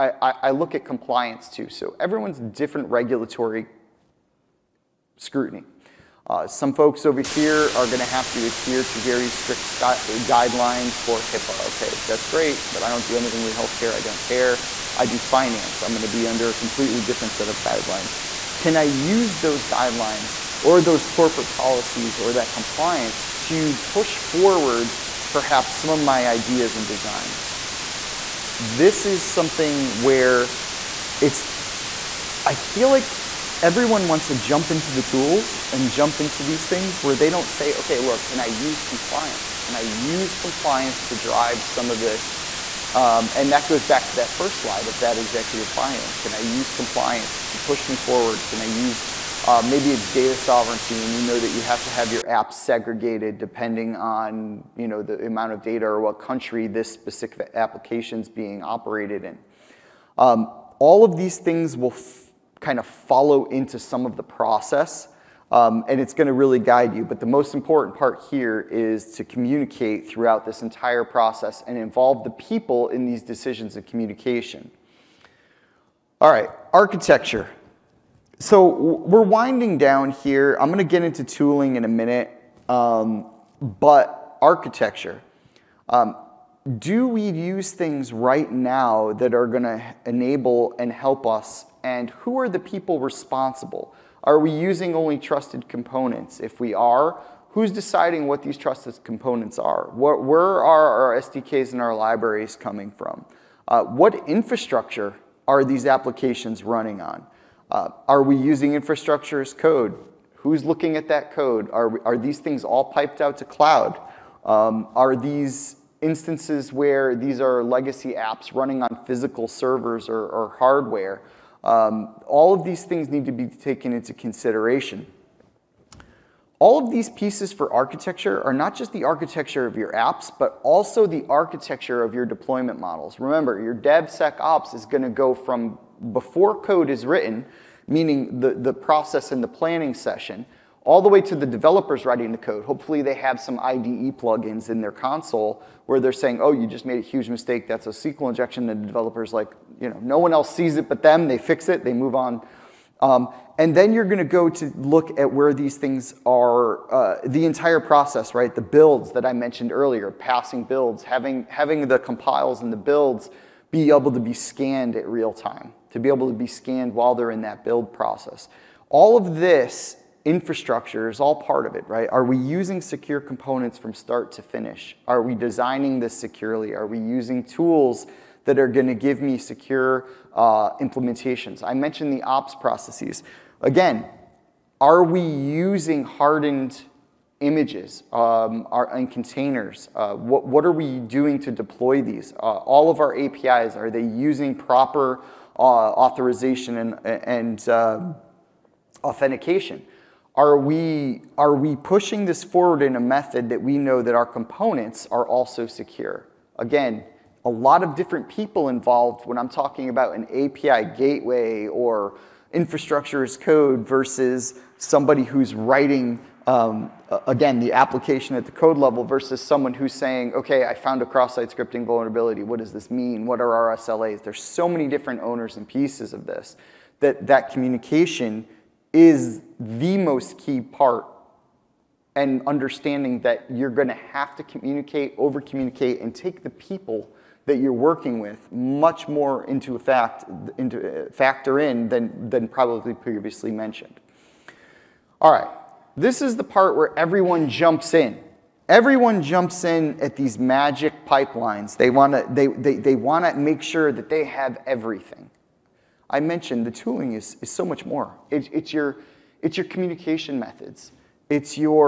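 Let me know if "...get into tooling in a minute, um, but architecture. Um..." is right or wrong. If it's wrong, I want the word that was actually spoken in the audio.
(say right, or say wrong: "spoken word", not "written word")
right.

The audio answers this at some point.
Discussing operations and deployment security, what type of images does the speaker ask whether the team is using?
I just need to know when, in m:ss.
3:06.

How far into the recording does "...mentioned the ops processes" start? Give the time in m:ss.
3:01.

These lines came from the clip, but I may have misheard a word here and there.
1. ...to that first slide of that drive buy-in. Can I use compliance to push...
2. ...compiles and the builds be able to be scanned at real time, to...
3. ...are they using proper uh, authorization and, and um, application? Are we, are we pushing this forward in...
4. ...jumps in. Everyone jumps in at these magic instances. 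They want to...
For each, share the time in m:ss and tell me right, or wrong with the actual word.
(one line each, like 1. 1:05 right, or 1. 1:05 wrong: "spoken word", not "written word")
1. 0:44 wrong: "executive", not "drive"
2. 2:41 right
3. 3:13 wrong: "authentication", not "application"
4. 4:07 wrong: "pipelines", not "instances".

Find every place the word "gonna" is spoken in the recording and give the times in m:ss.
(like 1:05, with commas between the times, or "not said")
2:34, 2:58.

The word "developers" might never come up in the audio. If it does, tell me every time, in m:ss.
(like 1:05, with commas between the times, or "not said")
2:21, 2:28.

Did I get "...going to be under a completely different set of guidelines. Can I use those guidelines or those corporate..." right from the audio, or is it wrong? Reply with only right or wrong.
right.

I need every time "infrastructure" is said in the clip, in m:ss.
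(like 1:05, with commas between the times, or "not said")
1:44, 1:48, 2:50, 3:32.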